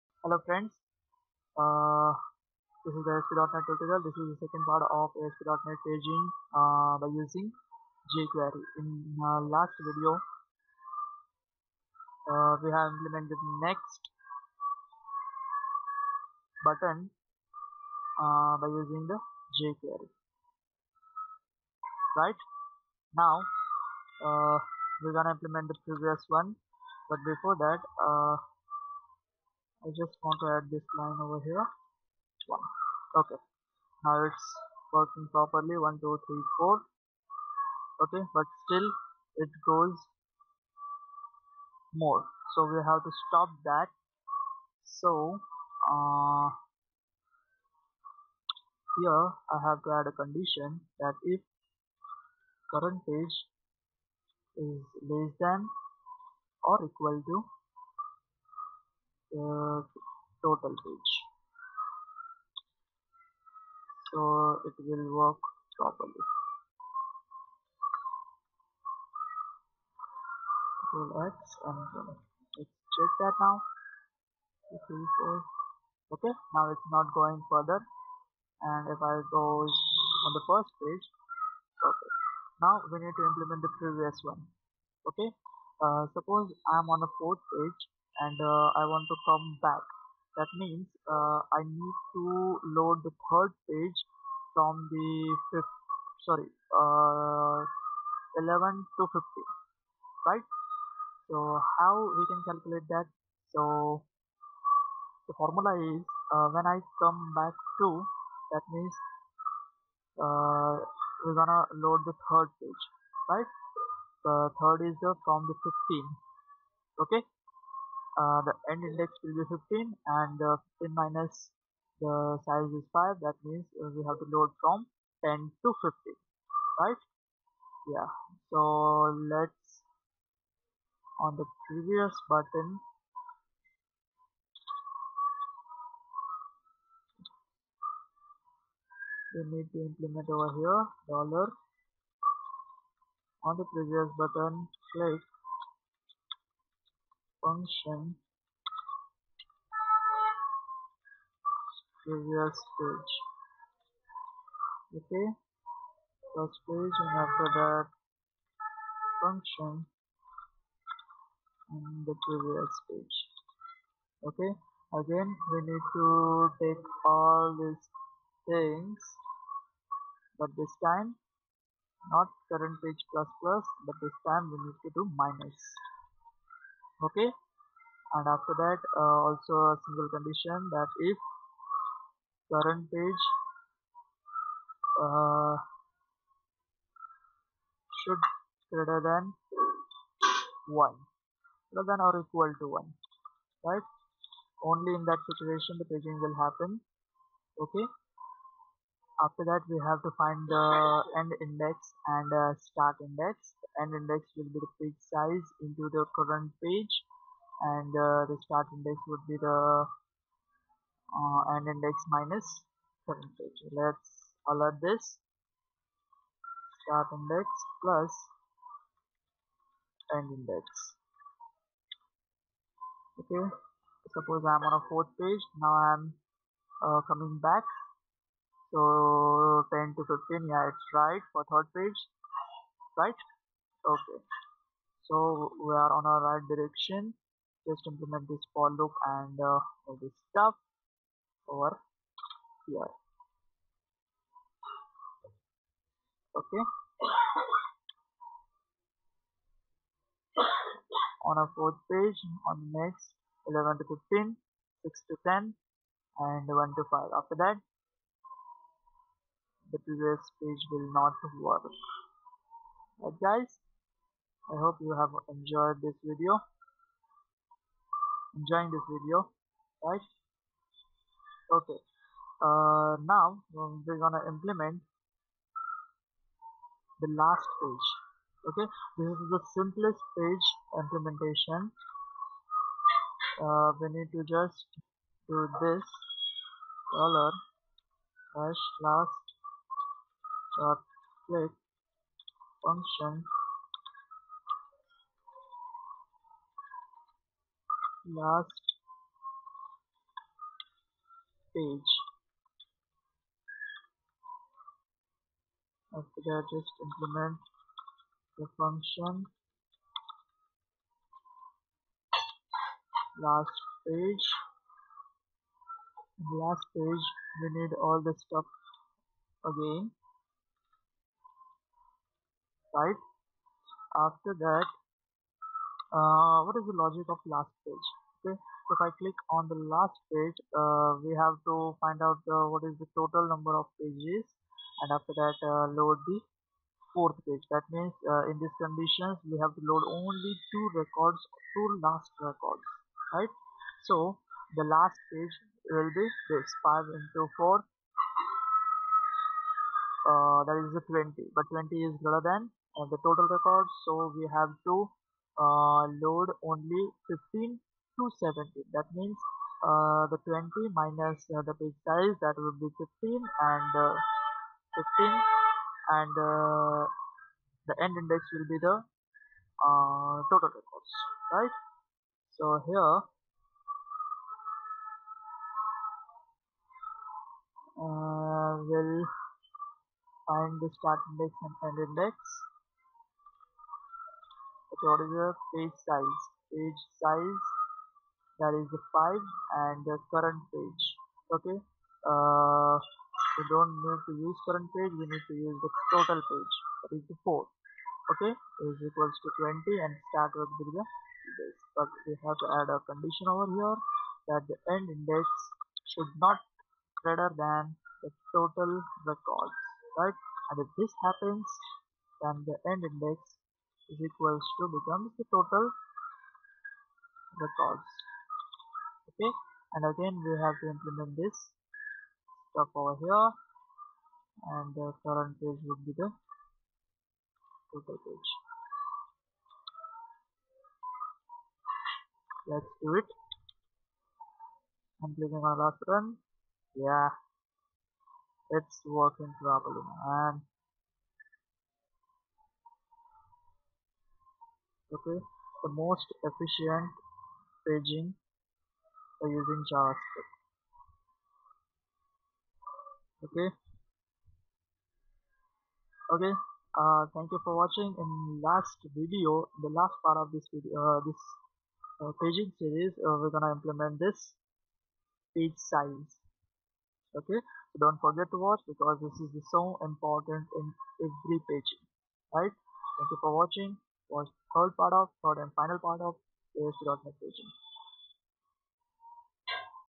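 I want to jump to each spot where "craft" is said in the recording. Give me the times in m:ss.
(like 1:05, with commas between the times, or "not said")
not said.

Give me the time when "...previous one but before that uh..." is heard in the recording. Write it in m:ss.
0:25.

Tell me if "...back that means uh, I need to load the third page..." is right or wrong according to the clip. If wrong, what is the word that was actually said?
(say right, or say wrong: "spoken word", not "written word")
right.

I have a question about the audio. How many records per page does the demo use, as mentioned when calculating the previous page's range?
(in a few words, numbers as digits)
5.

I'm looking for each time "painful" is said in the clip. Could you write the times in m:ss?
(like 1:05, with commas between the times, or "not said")
not said.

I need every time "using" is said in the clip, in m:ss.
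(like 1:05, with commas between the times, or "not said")
0:07, 0:18, 7:29.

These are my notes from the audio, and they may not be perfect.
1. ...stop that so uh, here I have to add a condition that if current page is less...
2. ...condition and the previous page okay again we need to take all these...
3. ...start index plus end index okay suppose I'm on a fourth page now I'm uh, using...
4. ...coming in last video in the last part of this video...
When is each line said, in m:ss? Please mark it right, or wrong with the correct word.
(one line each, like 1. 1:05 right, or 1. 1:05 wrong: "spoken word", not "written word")
1. 0:43 right
2. 2:39 wrong: "function", not "condition"
3. 3:36 wrong: "coming", not "using"
4. 7:37 wrong: "watching", not "coming".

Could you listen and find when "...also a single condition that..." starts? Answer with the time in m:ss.
2:59.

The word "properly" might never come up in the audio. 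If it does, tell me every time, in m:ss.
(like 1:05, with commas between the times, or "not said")
0:35, 1:05, 7:19.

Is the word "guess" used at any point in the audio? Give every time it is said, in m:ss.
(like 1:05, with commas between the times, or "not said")
not said.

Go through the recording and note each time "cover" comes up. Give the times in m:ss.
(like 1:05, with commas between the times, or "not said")
not said.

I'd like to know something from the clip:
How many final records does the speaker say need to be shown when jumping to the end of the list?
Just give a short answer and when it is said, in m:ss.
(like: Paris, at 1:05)
2, at 5:41.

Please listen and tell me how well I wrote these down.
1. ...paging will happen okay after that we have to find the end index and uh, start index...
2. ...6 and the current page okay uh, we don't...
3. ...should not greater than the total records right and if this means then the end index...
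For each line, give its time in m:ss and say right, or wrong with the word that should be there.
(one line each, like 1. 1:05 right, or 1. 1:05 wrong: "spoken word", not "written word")
1. 3:15 right
2. 6:28 wrong: "5", not "6"
3. 6:45 wrong: "happens", not "means".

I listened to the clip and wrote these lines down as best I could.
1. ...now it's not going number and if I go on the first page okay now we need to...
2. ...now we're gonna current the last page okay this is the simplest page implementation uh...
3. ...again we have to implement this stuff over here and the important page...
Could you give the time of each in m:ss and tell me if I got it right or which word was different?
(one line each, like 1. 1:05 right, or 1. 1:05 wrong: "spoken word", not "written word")
1. 1:14 wrong: "further", not "number"
2. 4:33 wrong: "implement", not "current"
3. 6:59 wrong: "current", not "important".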